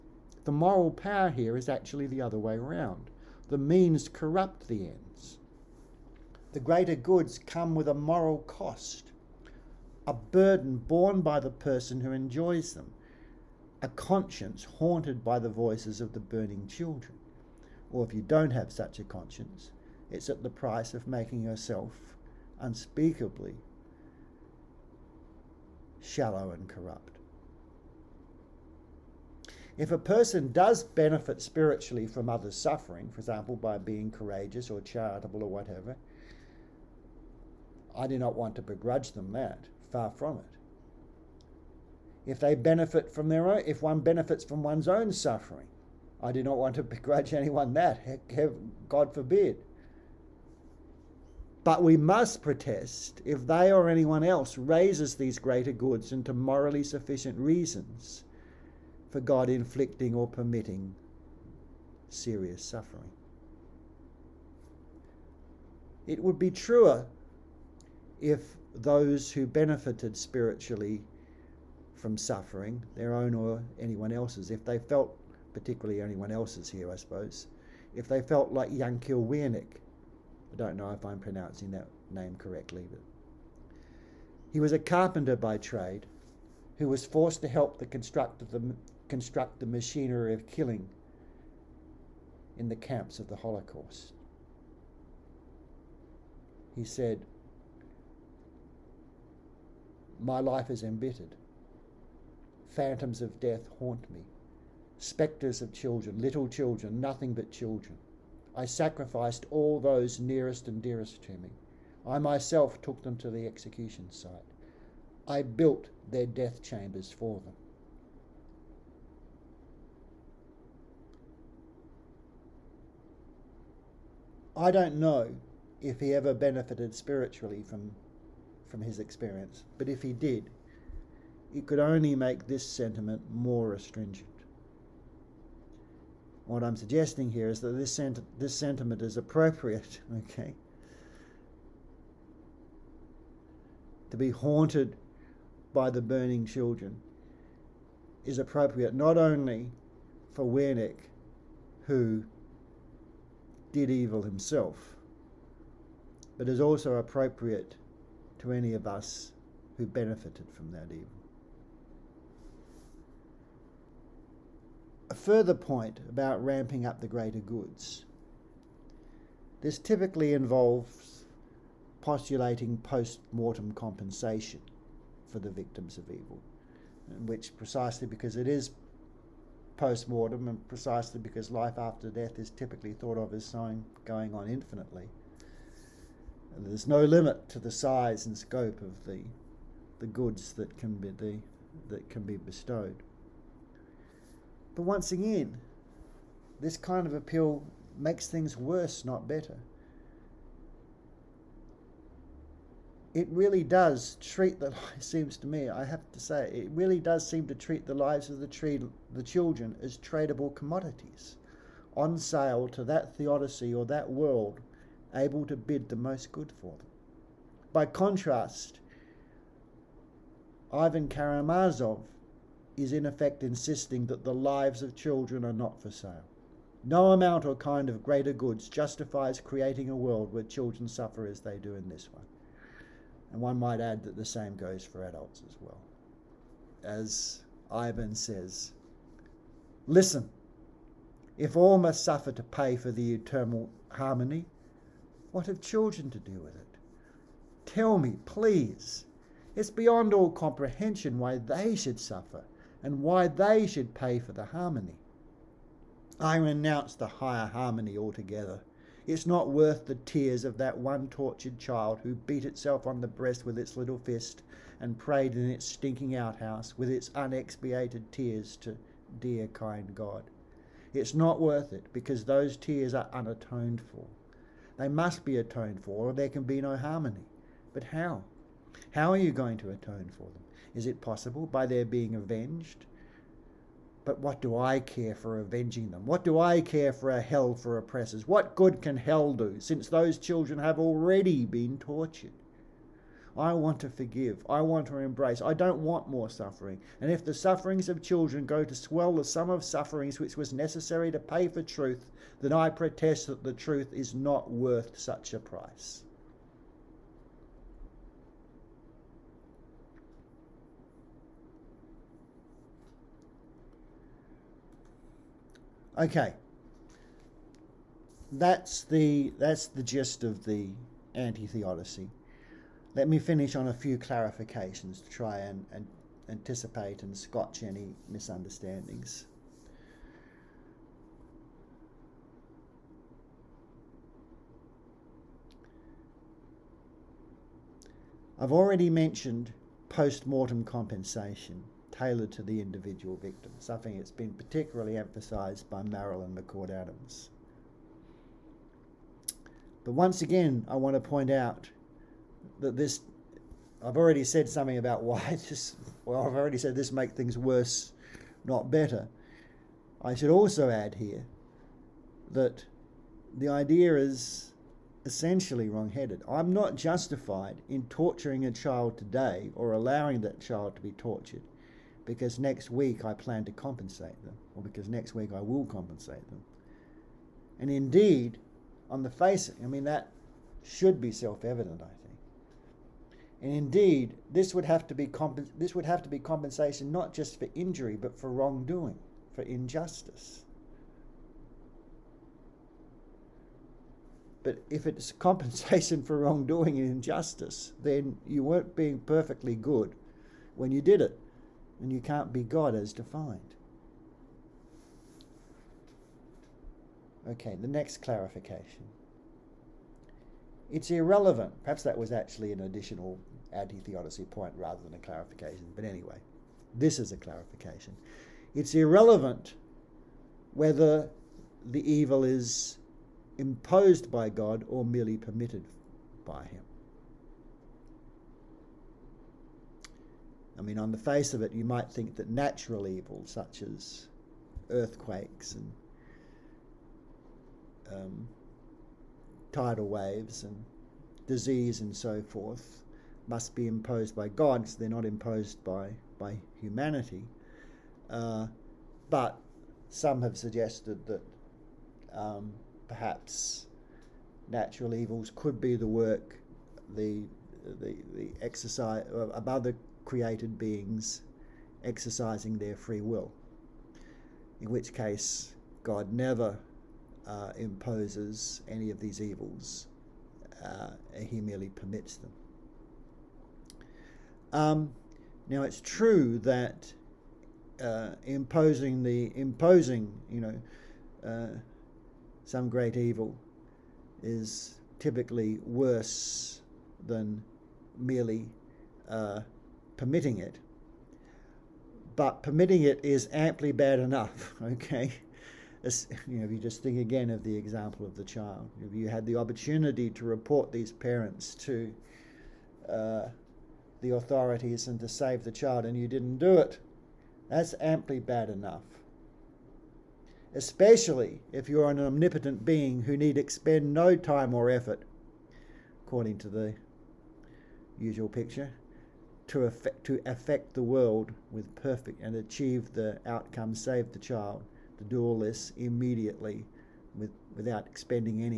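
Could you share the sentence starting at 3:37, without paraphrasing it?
By contrast, Ivan Karamazov is in effect insisting that the lives of children are not for sale.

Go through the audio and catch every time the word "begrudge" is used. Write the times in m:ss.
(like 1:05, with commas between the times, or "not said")
0:38, 0:46.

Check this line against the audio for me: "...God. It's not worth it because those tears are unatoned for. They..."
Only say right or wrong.
right.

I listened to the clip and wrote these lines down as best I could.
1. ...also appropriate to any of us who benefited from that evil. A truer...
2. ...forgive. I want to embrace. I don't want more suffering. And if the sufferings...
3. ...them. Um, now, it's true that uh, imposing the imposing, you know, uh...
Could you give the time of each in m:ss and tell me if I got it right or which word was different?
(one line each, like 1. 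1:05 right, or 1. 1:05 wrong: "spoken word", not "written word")
1. 2:36 wrong: "further", not "truer"
2. 4:53 right
3. 7:52 right.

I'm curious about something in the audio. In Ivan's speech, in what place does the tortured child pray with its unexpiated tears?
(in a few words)
Its stinking outhouse.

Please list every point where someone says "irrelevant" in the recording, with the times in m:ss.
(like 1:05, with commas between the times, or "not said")
6:50, 6:58.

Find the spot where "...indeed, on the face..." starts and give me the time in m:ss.
6:17.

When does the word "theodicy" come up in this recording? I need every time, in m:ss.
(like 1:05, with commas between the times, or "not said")
3:33, 5:21, 6:53.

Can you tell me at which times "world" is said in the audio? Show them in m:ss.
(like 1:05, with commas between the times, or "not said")
3:34, 3:49, 8:40.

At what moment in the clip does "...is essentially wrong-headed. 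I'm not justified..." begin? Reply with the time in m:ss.
6:03.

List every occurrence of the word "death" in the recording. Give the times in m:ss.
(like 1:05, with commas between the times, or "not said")
1:43, 1:56, 3:02.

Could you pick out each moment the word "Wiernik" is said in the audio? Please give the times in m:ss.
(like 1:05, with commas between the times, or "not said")
1:19, 2:30.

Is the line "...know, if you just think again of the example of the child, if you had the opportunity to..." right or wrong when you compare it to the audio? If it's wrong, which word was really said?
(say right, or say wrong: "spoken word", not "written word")
right.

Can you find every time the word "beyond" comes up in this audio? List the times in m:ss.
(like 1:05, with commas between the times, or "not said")
4:09.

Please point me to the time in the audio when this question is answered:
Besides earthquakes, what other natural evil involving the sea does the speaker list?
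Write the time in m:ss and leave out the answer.
7:19.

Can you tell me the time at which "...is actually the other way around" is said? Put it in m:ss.
0:01.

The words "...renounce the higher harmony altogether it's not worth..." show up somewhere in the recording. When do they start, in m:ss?
4:16.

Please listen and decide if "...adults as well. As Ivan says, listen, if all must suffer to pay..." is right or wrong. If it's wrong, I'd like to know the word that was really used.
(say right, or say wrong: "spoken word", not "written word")
right.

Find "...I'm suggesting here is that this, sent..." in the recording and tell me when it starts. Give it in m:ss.
2:16.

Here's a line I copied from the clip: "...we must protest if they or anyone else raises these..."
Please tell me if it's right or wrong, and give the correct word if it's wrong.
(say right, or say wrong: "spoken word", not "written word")
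right.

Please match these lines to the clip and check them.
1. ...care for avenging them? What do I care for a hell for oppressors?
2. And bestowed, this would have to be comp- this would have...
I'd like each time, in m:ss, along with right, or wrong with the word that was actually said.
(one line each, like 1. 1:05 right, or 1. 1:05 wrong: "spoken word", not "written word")
1. 4:44 right
2. 6:23 wrong: "indeed", not "bestowed".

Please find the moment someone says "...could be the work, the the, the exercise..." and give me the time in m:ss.
7:35.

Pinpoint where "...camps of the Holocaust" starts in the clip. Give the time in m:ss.
1:32.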